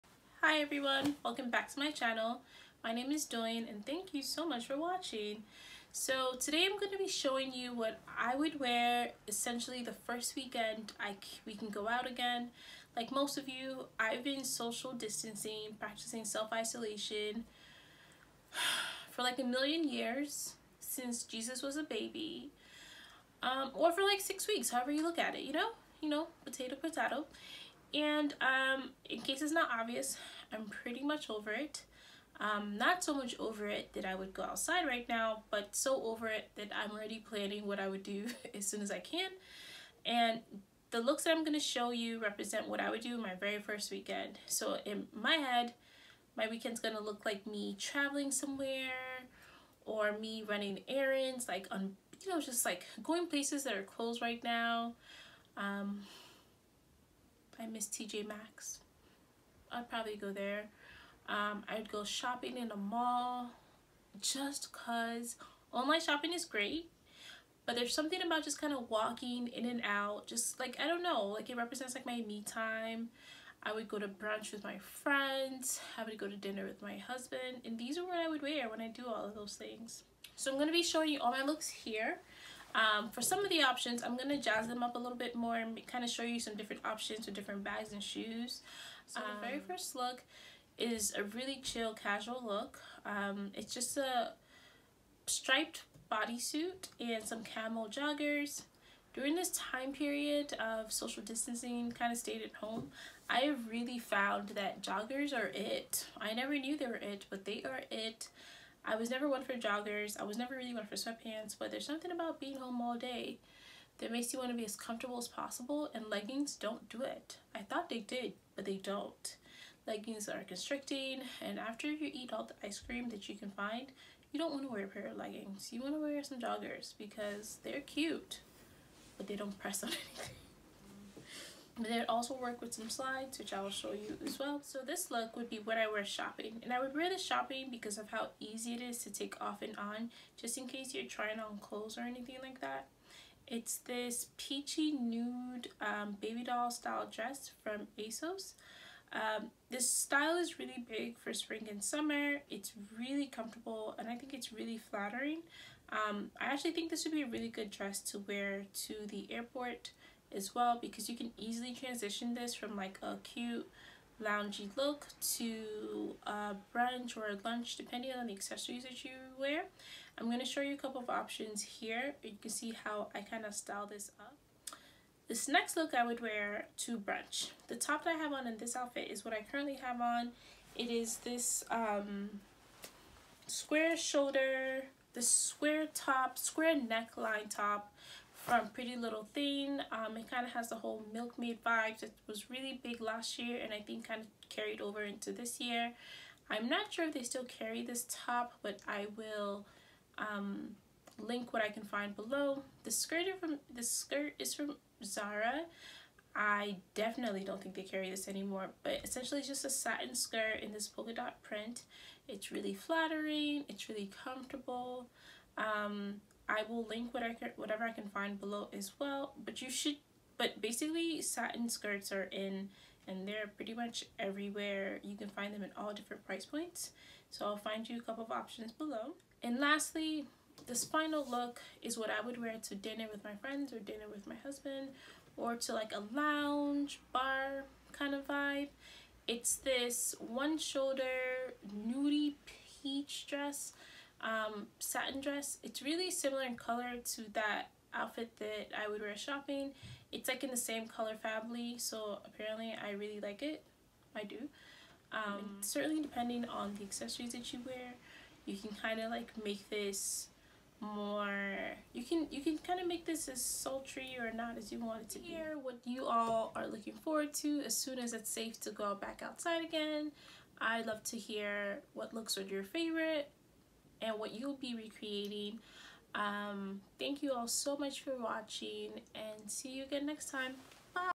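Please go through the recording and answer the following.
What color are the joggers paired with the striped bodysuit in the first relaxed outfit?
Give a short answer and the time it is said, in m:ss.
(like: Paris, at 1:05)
Camel, at 1:37.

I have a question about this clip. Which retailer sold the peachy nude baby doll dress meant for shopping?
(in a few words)
ASOS.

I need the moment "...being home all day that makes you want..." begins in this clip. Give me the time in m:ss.
1:52.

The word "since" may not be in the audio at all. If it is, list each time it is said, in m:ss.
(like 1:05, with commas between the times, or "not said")
0:20.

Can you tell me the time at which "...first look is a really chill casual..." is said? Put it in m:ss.
1:29.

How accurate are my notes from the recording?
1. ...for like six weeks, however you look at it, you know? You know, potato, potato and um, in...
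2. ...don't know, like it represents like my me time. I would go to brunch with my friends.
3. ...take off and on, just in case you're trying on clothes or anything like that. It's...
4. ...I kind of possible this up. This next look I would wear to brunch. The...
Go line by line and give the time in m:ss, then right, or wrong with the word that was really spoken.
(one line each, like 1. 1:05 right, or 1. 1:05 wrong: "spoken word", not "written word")
1. 0:23 right
2. 1:10 right
3. 2:19 right
4. 2:53 wrong: "style", not "possible".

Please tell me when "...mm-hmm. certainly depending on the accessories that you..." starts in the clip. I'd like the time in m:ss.
4:15.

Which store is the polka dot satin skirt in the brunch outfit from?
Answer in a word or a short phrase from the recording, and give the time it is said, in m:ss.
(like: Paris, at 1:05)
Zara, at 3:25.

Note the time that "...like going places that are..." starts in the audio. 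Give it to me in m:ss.
0:52.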